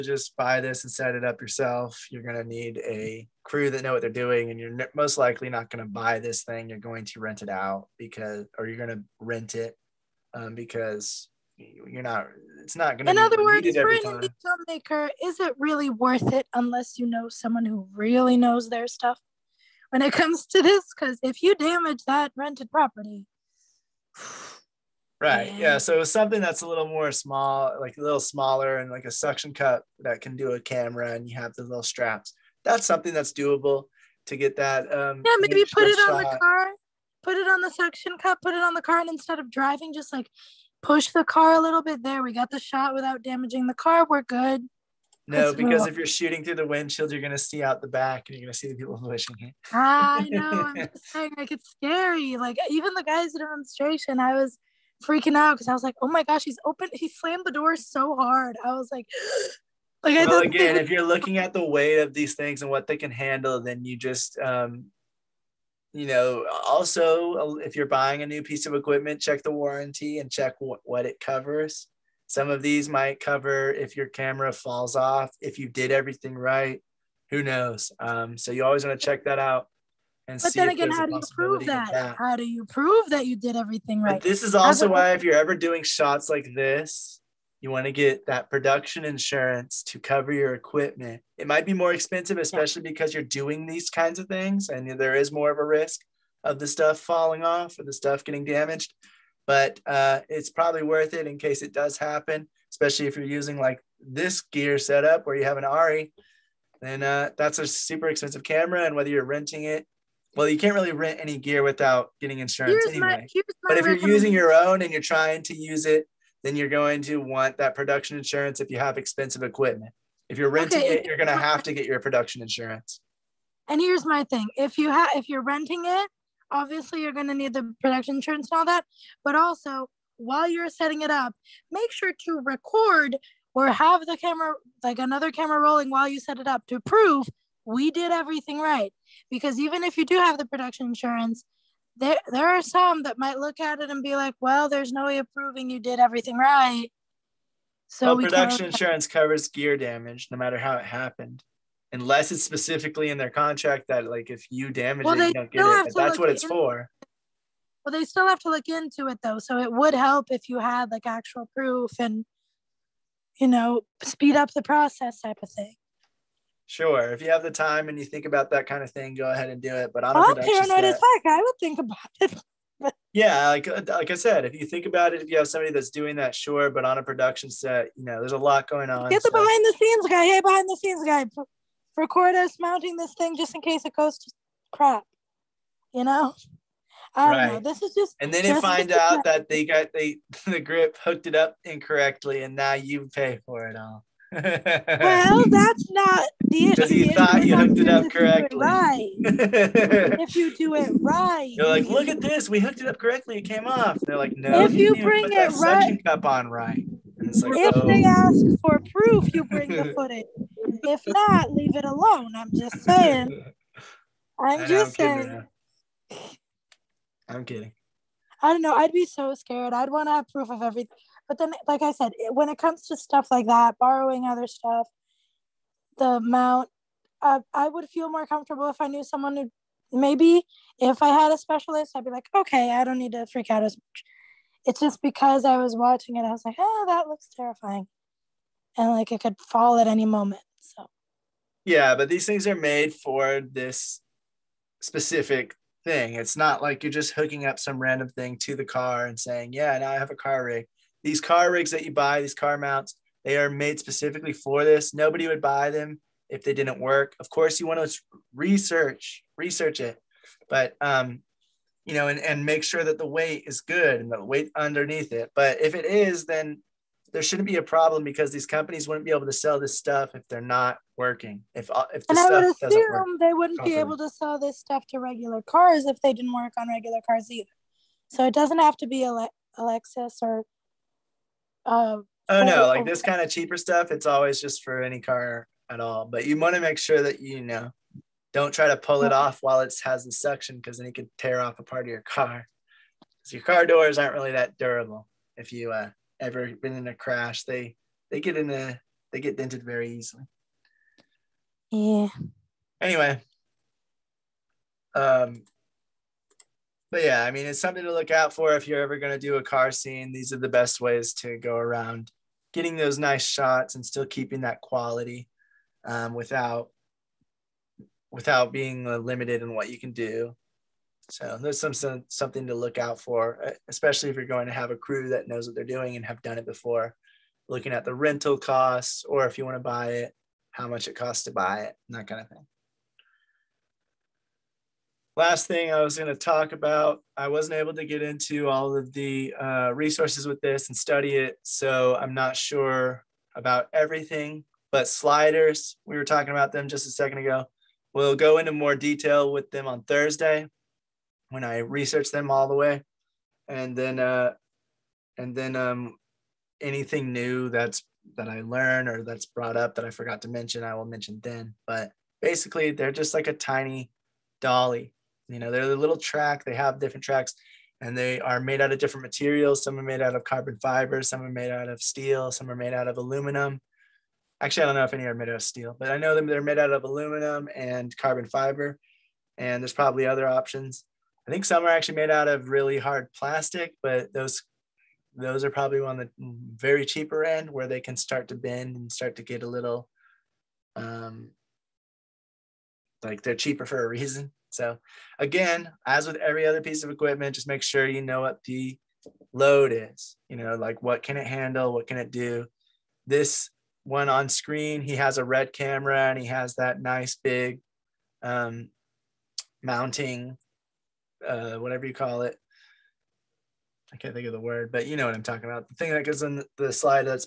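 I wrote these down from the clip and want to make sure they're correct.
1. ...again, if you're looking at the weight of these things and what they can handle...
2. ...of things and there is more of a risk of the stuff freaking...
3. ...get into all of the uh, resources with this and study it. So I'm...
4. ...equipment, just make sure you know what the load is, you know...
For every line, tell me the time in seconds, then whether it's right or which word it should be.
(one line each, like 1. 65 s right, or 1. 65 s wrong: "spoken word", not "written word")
1. 60 s right
2. 94 s wrong: "falling", not "freaking"
3. 337 s right
4. 396 s right.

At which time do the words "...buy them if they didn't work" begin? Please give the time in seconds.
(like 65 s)
255 s.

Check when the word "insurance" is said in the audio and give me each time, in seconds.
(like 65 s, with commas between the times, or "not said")
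89 s, 112 s, 118 s, 122 s, 128 s, 140 s, 148 s.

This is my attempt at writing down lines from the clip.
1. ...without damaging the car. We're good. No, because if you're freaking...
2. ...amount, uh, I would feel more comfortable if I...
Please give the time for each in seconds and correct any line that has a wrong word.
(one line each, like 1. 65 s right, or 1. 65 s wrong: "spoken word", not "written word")
1. 42 s wrong: "shooting", not "freaking"
2. 226 s right.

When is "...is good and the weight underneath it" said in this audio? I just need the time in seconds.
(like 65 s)
263 s.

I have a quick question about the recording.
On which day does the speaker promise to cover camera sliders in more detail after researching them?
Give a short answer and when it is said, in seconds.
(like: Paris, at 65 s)
Thursday, at 349 s.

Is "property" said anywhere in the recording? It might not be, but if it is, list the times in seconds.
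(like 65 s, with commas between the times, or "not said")
22 s.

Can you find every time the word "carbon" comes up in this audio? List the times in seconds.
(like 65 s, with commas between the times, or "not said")
370 s, 377 s.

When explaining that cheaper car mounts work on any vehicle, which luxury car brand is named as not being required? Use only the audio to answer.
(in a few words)
Lexus.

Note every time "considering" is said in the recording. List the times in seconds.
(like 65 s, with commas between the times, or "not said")
not said.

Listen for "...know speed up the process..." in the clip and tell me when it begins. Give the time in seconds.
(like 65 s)
163 s.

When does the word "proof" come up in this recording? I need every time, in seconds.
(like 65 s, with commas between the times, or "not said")
161 s, 208 s, 220 s.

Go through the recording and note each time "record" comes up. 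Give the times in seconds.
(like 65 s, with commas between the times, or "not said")
132 s, 181 s.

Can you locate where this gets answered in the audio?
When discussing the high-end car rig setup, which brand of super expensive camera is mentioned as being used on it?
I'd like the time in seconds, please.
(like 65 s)
105 s.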